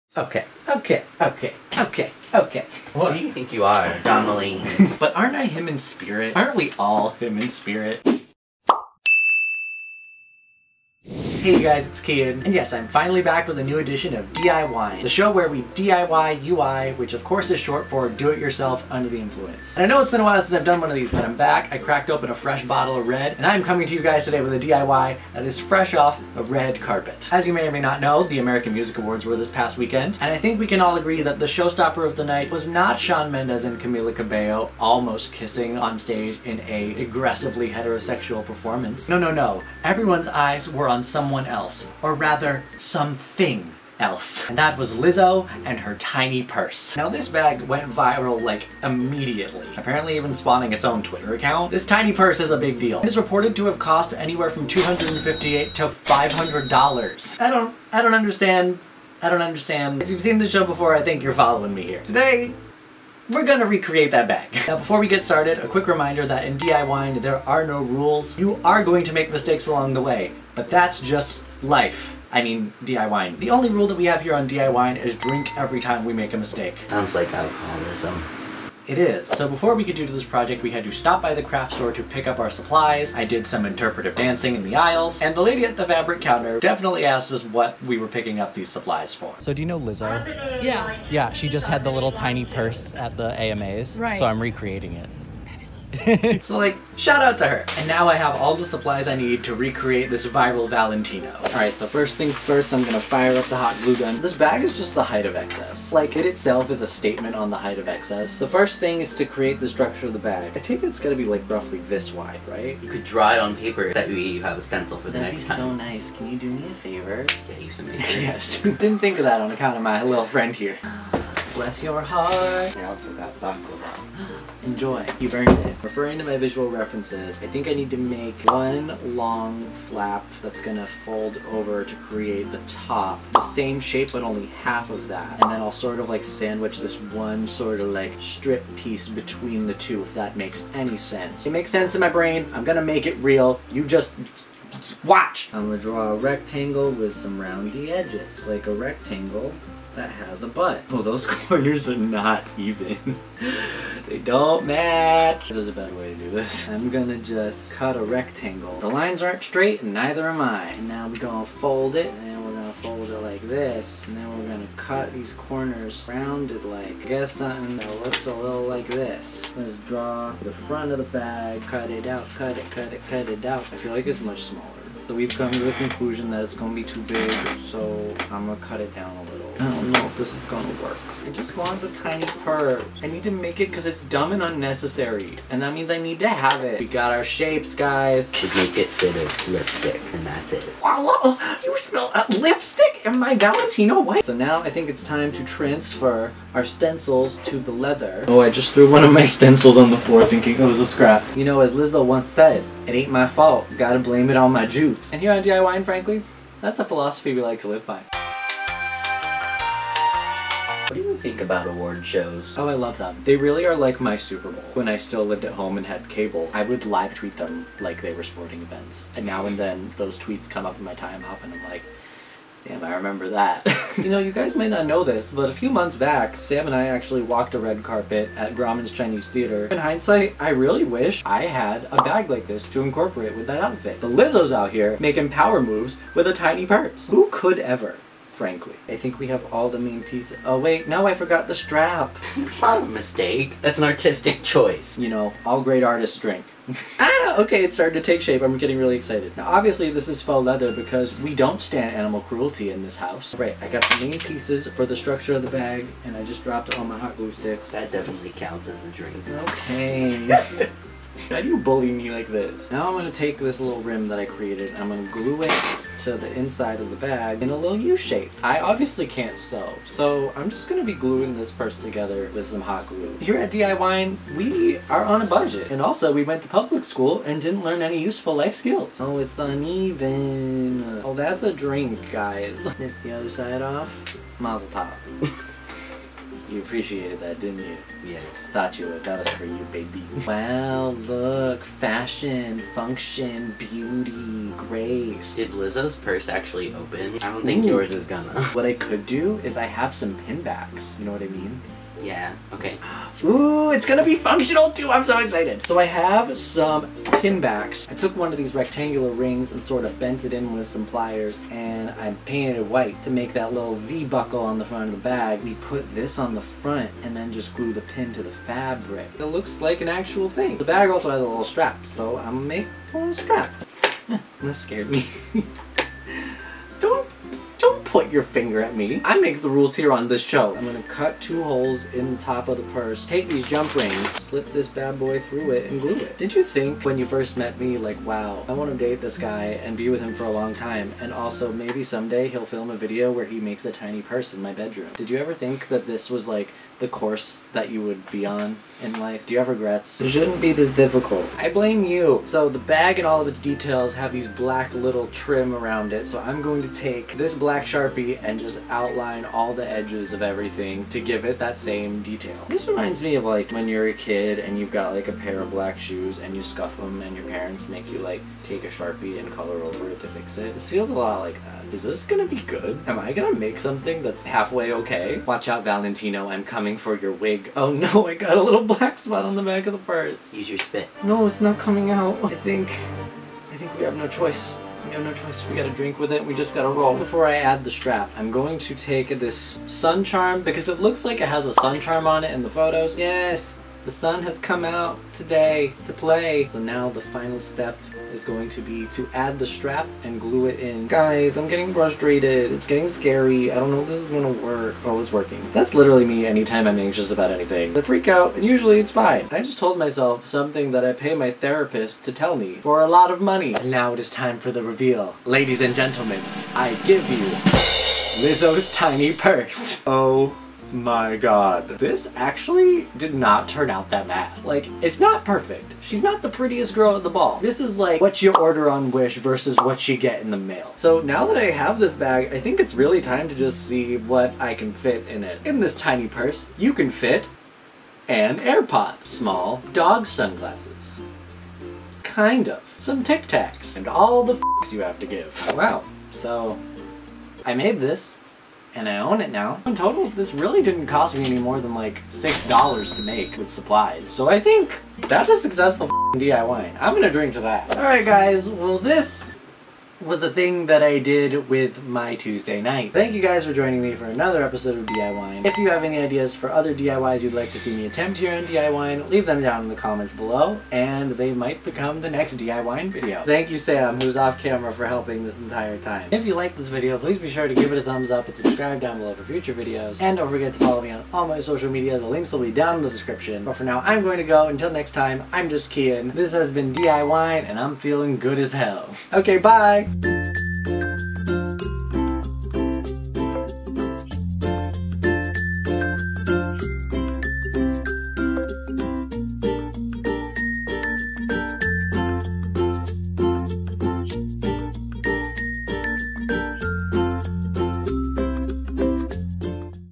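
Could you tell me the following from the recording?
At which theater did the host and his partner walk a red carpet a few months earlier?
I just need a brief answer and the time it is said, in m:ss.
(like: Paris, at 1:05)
Grauman's Chinese Theater, at 3:48.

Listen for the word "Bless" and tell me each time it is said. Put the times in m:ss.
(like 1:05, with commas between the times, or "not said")
2:01.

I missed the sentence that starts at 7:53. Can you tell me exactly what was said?
Thank you, Sam, who's off camera for helping this entire time.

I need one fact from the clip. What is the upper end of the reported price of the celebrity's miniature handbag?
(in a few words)
$500.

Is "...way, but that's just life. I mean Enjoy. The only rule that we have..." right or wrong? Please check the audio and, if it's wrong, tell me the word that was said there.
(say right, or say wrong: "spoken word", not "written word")
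wrong: "DIYing", not "Enjoy".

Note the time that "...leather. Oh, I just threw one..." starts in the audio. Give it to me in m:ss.
3:17.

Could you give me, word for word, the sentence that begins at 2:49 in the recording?
Let's draw the front of the bag, cut it out, cut it, cut it, cut it out.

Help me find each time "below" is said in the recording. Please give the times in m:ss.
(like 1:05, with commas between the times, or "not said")
7:50, 7:58.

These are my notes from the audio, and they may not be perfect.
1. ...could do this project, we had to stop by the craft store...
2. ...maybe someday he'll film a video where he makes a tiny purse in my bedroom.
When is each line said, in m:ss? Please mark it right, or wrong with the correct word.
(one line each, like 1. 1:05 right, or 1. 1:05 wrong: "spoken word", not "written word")
1. 1:19 right
2. 5:41 right.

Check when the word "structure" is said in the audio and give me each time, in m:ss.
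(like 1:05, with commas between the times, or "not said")
1:49, 4:14.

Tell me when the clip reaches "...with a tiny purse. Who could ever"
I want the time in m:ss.
3:56.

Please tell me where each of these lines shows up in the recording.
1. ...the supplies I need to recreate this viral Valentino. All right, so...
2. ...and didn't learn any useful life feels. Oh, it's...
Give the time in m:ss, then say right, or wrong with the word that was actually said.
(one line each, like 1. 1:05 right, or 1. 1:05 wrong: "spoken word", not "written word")
1. 1:38 right
2. 4:37 wrong: "skills", not "feels".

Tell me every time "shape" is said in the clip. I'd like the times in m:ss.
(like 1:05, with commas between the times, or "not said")
2:13, 3:07, 4:08, 4:27.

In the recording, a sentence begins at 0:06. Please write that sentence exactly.
Aren't we all him in spirit?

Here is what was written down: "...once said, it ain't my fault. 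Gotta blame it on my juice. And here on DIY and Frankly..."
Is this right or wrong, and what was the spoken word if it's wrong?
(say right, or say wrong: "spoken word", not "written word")
right.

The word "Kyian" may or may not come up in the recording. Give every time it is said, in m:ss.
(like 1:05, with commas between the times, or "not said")
0:12, 8:05.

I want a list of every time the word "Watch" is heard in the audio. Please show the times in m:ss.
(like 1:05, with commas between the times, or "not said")
2:25, 6:15.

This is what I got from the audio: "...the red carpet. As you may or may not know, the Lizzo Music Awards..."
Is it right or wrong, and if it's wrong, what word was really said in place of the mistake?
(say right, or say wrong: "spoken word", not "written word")
wrong: "American", not "Lizzo".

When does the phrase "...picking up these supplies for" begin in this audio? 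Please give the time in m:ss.
1:28.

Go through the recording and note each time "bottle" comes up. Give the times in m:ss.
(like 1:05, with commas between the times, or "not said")
0:22.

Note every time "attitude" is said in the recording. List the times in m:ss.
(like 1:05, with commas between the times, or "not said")
not said.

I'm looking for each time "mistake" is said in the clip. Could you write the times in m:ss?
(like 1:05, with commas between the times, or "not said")
1:09, 1:16, 4:02.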